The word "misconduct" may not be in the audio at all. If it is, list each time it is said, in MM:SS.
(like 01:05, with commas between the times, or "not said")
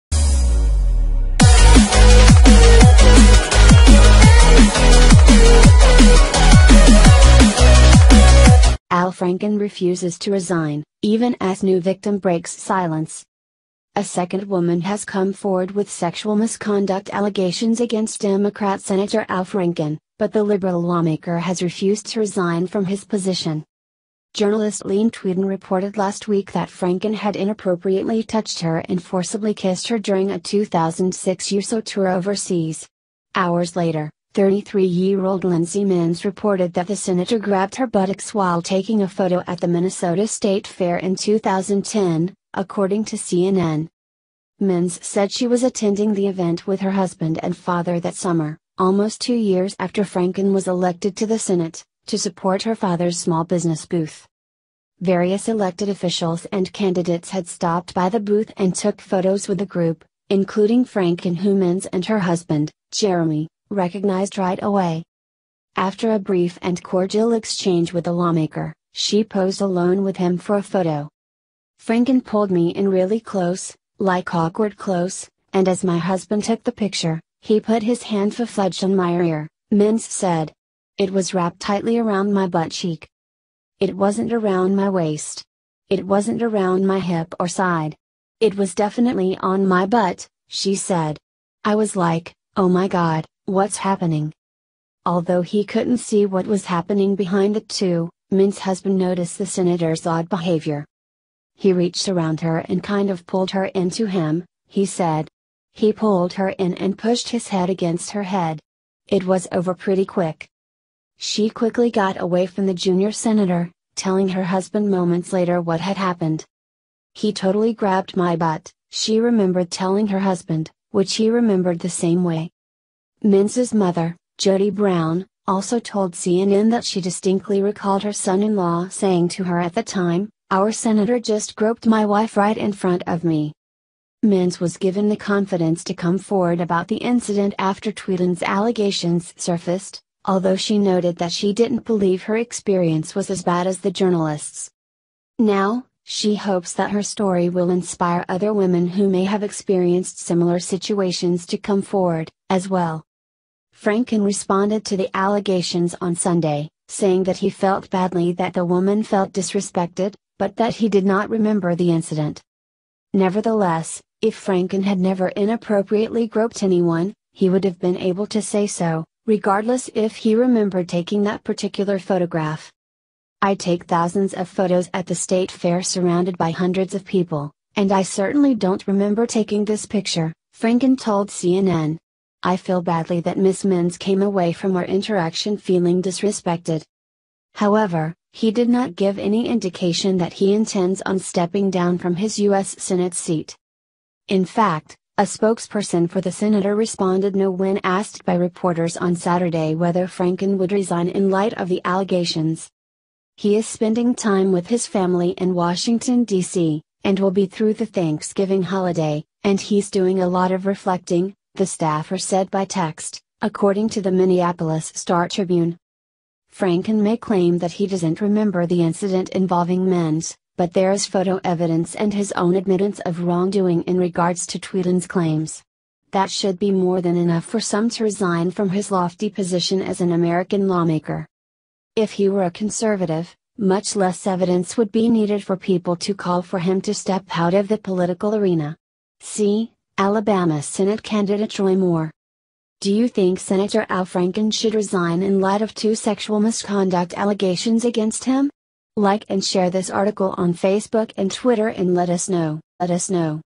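00:16, 04:06.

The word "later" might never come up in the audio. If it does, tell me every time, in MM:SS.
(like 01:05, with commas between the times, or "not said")
00:33, 01:55.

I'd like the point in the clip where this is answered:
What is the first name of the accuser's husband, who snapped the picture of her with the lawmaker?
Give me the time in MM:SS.
01:02.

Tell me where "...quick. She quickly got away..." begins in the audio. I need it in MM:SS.
01:50.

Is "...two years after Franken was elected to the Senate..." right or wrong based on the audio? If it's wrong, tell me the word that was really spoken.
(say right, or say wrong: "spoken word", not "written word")
right.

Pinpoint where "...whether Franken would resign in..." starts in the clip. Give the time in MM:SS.
03:19.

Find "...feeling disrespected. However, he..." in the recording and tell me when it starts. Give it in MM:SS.
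03:05.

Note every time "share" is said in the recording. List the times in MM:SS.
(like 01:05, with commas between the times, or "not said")
04:09.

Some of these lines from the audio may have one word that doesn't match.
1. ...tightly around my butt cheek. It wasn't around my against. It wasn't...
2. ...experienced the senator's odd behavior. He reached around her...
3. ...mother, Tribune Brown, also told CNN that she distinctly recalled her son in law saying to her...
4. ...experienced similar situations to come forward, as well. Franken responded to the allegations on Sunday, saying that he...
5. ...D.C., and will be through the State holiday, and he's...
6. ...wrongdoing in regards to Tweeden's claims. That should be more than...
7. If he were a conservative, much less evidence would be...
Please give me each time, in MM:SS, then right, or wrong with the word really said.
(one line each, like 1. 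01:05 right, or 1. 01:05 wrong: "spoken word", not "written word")
1. 01:21 wrong: "waist", not "against"
2. 01:38 wrong: "noticed", not "experienced"
3. 02:03 wrong: "Jody", not "Tribune"
4. 02:29 right
5. 03:26 wrong: "Thanksgiving", not "State"
6. 03:43 right
7. 03:51 right.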